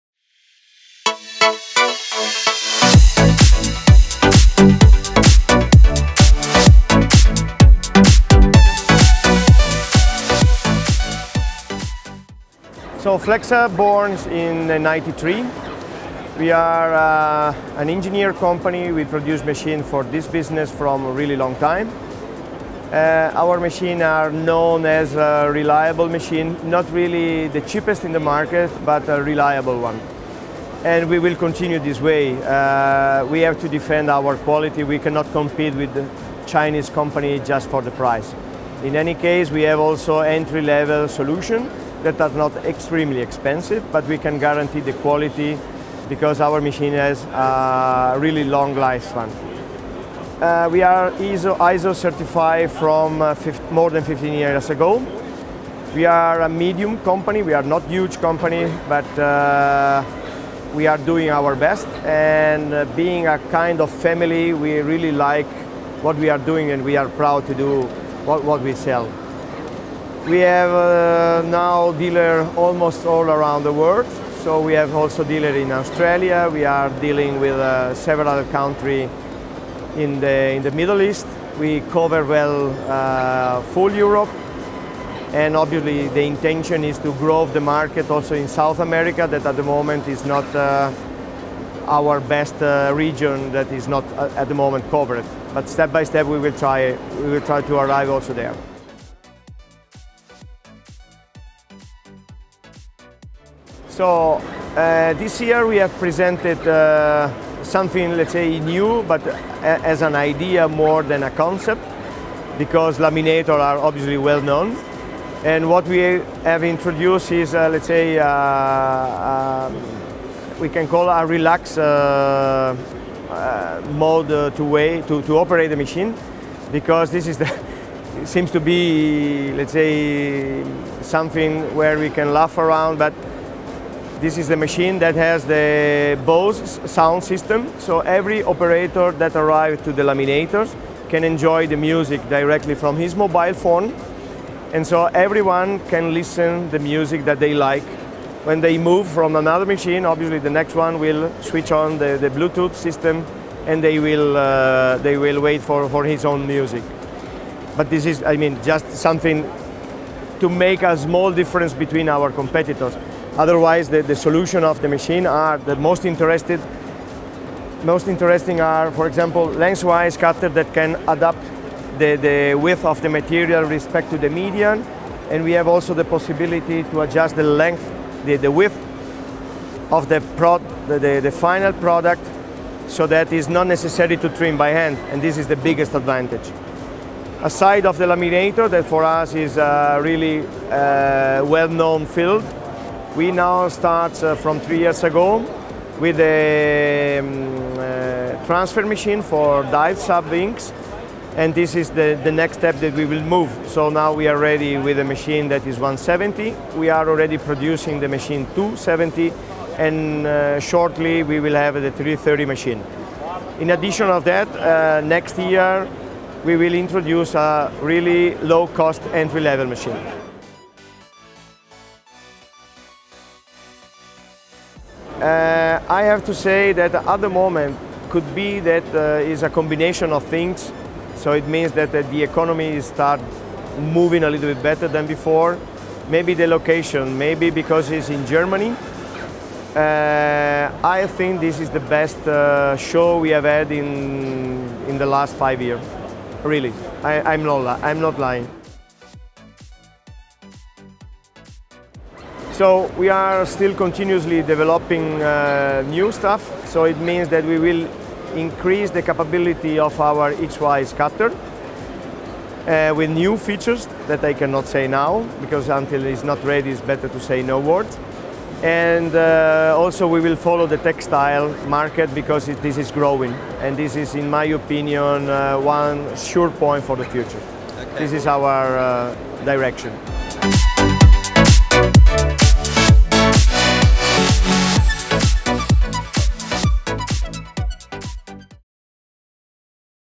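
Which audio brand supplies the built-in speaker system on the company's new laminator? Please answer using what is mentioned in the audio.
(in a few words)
Bose.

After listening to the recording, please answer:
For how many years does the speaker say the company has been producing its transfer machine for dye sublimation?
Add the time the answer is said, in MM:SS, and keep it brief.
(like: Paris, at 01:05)
3, at 03:14.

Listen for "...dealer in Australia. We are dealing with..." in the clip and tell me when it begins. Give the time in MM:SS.
01:15.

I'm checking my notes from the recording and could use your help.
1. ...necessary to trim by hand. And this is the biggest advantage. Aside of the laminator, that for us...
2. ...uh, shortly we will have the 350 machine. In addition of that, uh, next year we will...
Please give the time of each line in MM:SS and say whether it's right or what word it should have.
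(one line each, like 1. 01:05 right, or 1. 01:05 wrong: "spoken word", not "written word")
1. 03:03 right
2. 03:30 wrong: "330", not "350".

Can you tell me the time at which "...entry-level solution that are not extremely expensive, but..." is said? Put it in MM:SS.
00:40.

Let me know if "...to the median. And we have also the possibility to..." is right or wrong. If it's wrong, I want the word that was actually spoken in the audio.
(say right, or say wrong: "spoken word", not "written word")
right.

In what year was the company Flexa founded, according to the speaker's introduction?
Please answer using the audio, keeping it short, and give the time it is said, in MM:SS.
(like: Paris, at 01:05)
1993, at 00:14.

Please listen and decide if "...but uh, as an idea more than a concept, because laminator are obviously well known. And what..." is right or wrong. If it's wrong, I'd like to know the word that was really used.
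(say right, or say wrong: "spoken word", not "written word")
right.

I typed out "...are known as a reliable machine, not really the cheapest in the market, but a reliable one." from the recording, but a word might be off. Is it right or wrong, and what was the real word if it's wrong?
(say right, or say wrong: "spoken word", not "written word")
right.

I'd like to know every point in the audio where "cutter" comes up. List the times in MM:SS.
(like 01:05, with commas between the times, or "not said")
02:50, 04:20.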